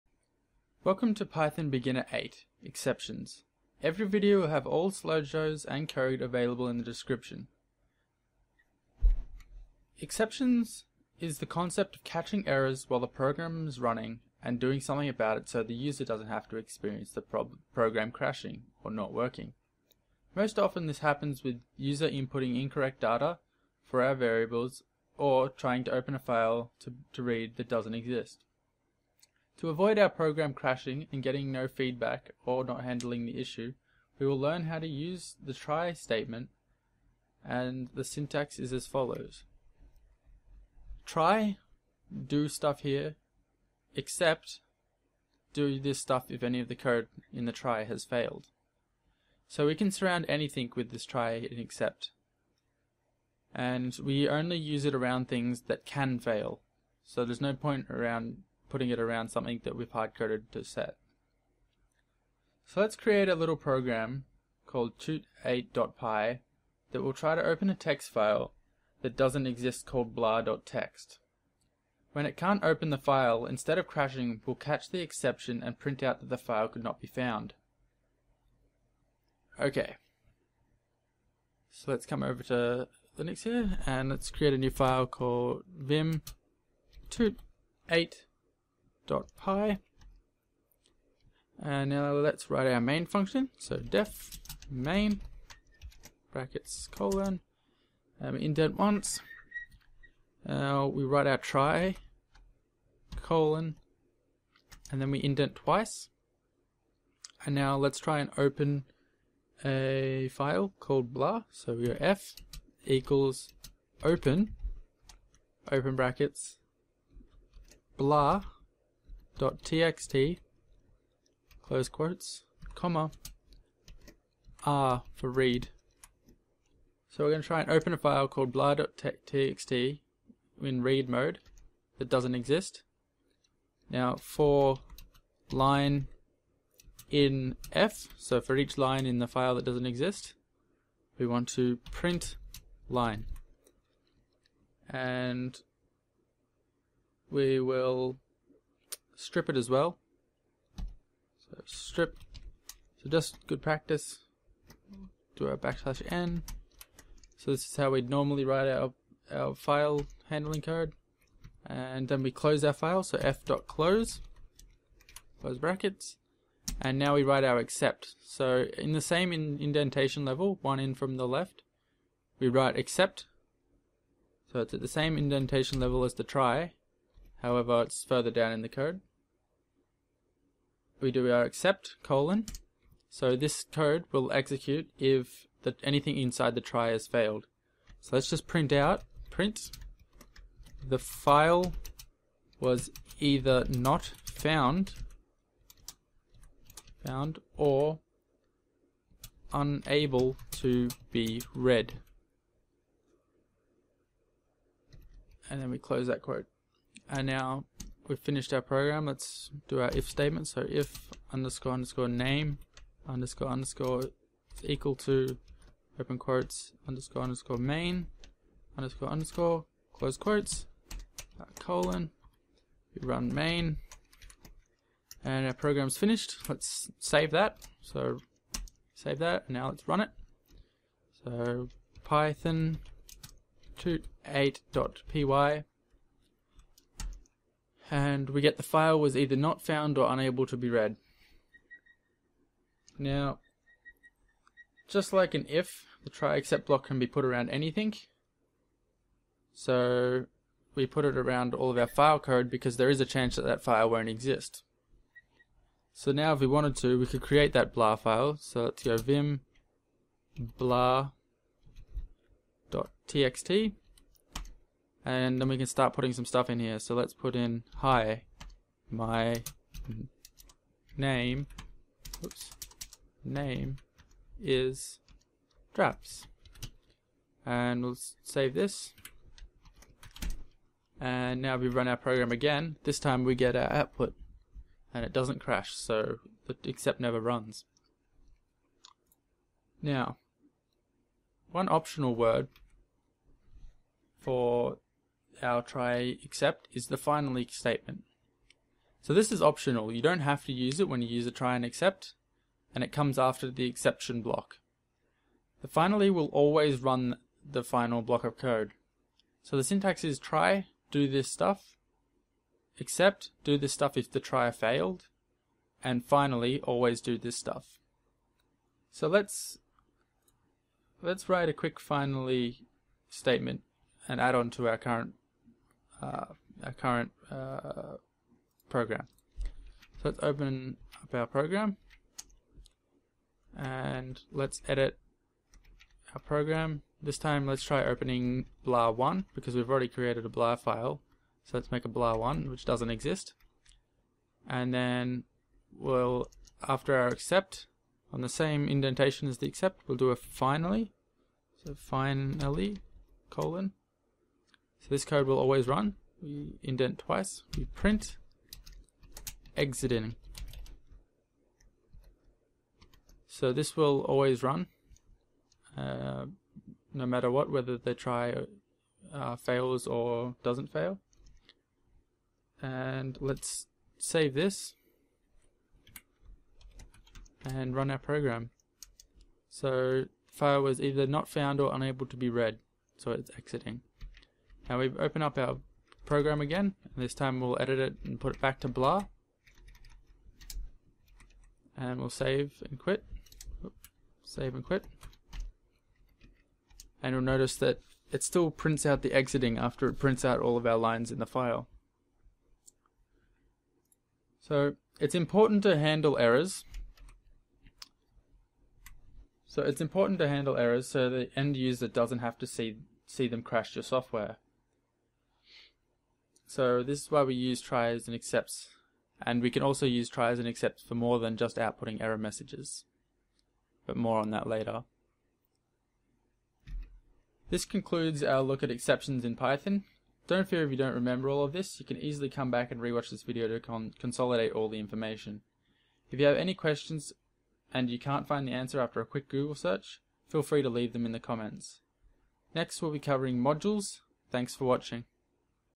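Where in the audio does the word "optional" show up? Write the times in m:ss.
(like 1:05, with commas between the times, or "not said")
4:51, 4:59.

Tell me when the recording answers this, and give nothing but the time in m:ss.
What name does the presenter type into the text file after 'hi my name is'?
4:35.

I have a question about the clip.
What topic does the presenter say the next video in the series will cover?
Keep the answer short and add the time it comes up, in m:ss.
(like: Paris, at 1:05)
modules, at 7:23.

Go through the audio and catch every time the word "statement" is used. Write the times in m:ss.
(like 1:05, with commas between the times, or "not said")
0:35, 3:30, 4:57, 5:23.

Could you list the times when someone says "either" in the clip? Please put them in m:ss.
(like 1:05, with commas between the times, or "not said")
3:13, 3:59, 6:20.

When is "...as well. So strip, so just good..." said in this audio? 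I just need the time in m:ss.
2:29.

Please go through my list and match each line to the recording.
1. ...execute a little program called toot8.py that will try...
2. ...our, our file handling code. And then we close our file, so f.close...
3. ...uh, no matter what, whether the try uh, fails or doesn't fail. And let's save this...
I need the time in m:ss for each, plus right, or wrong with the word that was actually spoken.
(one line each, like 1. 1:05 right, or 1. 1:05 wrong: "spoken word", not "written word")
1. 1:02 wrong: "create", not "execute"
2. 2:38 right
3. 6:05 right.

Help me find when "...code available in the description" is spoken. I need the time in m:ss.
0:05.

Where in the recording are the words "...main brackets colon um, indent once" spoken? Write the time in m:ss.
1:34.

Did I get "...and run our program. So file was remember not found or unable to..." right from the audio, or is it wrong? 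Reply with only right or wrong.
wrong.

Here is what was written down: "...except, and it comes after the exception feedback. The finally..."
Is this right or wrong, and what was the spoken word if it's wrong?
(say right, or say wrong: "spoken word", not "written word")
wrong: "block", not "feedback".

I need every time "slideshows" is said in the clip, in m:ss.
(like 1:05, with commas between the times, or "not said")
0:04.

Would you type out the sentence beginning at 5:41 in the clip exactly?
So let's make a blah1 which doesn't exist.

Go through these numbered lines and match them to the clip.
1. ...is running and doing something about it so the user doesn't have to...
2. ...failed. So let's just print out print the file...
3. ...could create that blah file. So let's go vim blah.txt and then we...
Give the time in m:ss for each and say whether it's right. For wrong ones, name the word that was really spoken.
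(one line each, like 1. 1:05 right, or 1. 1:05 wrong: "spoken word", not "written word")
1. 0:13 right
2. 3:07 right
3. 4:17 right.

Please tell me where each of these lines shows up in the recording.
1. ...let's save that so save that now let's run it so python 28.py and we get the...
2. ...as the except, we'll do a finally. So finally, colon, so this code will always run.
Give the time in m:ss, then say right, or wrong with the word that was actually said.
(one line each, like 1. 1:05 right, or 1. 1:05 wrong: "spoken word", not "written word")
1. 3:46 right
2. 5:49 right.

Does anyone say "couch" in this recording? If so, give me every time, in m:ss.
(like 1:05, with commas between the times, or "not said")
not said.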